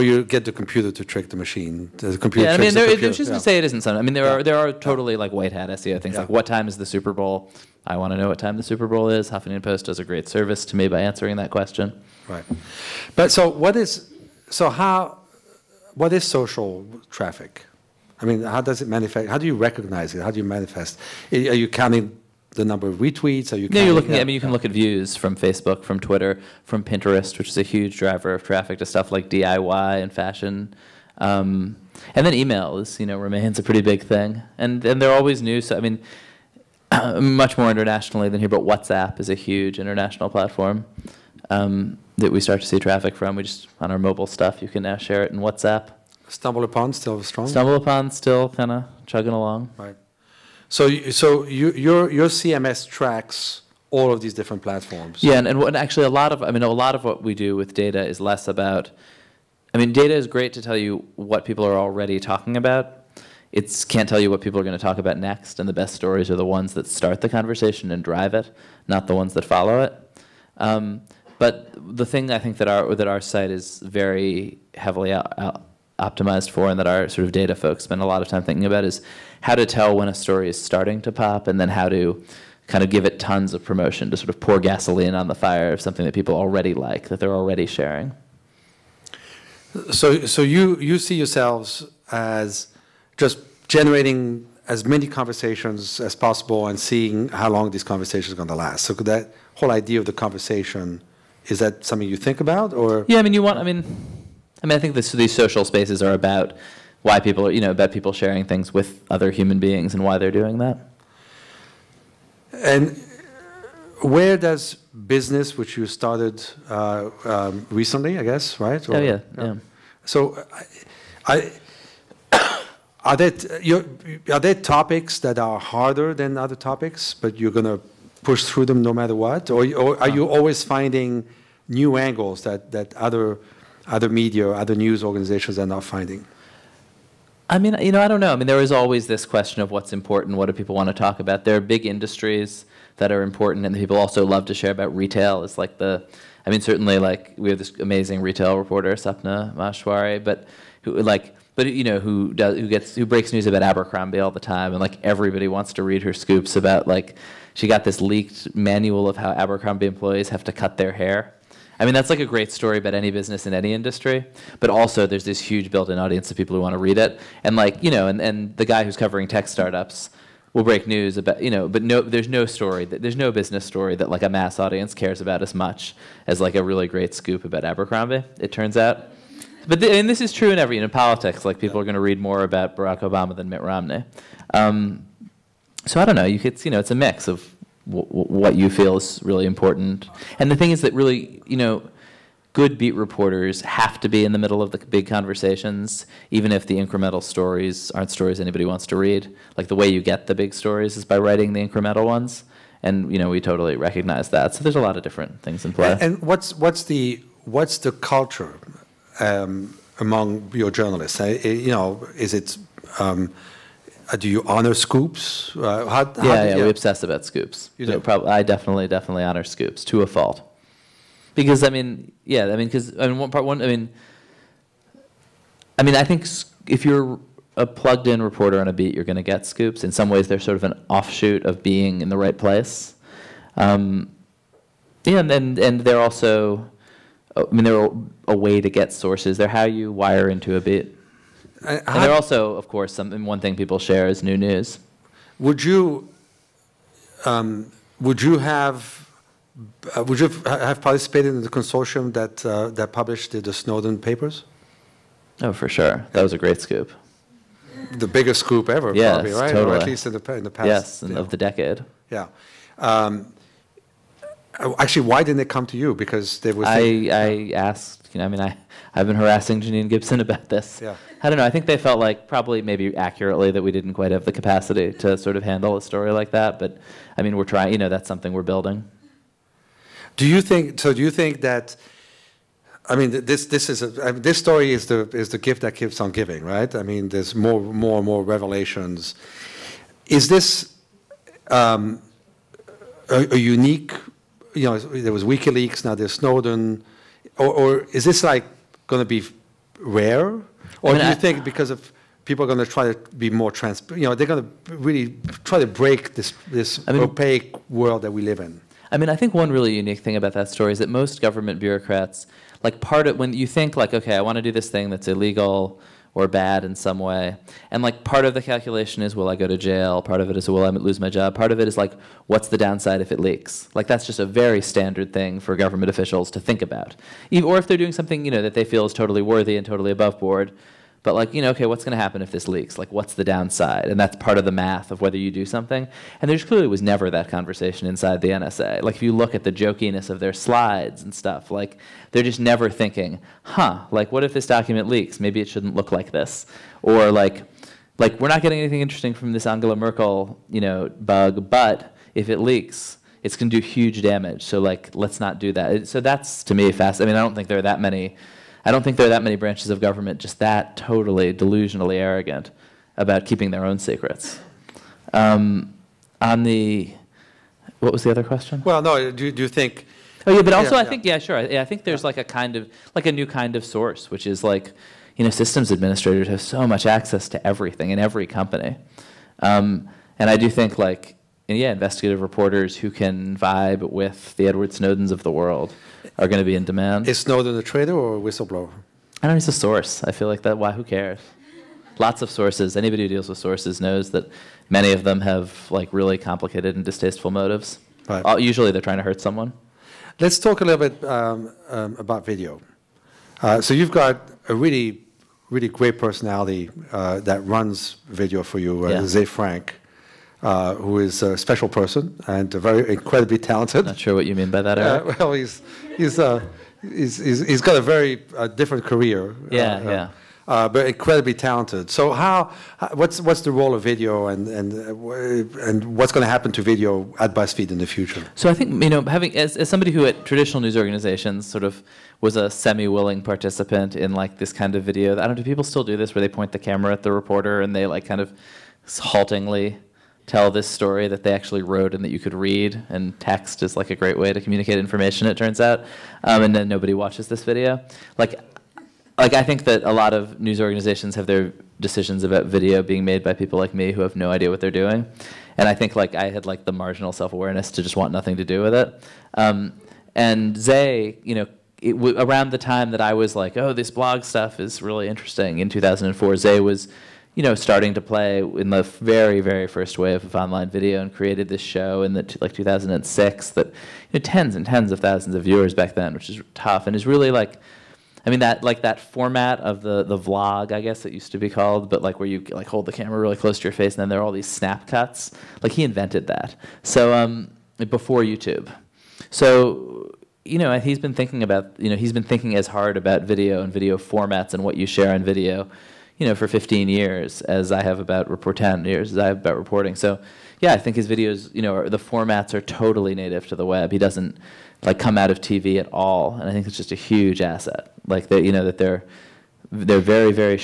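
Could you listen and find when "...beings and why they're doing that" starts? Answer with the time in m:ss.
1:49.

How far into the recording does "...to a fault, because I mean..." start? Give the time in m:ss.
3:39.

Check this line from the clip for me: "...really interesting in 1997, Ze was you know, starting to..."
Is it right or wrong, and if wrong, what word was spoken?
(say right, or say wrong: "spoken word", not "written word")
wrong: "2004", not "1997".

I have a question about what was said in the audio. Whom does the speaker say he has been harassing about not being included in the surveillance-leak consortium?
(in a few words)
Janine Gibson.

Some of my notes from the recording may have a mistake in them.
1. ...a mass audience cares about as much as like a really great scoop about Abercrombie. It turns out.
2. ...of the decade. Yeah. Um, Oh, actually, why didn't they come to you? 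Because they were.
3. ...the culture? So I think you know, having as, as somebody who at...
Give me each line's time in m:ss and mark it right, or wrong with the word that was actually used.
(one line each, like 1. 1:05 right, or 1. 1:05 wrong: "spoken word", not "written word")
1. 2:54 right
2. 4:21 right
3. 7:07 wrong: "future", not "culture".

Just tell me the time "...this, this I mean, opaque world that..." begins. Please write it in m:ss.
5:06.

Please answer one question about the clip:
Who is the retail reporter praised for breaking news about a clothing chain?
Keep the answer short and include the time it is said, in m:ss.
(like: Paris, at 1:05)
Sapna Maheshwari, at 2:28.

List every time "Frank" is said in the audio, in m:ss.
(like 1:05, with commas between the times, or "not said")
6:49.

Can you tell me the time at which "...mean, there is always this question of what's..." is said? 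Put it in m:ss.
2:18.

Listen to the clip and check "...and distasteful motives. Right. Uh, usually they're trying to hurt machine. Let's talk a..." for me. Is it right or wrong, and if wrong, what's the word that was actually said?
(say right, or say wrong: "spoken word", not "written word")
wrong: "someone", not "machine".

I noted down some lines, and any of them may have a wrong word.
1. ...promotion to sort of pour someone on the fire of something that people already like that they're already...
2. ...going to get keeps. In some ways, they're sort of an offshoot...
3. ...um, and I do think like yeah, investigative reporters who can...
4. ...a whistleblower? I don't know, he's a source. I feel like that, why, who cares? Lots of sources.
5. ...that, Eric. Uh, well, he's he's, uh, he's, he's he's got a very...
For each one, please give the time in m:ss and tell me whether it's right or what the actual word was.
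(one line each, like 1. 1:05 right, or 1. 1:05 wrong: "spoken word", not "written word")
1. 1:23 wrong: "gasoline", not "someone"
2. 3:49 wrong: "scoops", not "keeps"
3. 6:19 right
4. 6:28 right
5. 6:54 right.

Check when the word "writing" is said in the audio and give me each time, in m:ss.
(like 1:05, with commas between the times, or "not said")
3:21.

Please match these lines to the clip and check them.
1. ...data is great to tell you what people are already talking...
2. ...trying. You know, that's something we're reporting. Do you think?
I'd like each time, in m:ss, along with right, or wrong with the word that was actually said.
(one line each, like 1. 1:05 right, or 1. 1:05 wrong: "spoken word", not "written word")
1. 0:59 right
2. 4:37 wrong: "building", not "reporting".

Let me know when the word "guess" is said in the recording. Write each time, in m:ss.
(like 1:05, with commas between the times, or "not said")
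1:58, 8:00.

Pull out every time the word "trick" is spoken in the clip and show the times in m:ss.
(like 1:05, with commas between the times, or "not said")
0:01.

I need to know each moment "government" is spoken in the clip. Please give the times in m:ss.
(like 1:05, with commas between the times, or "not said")
5:11, 5:25, 5:59.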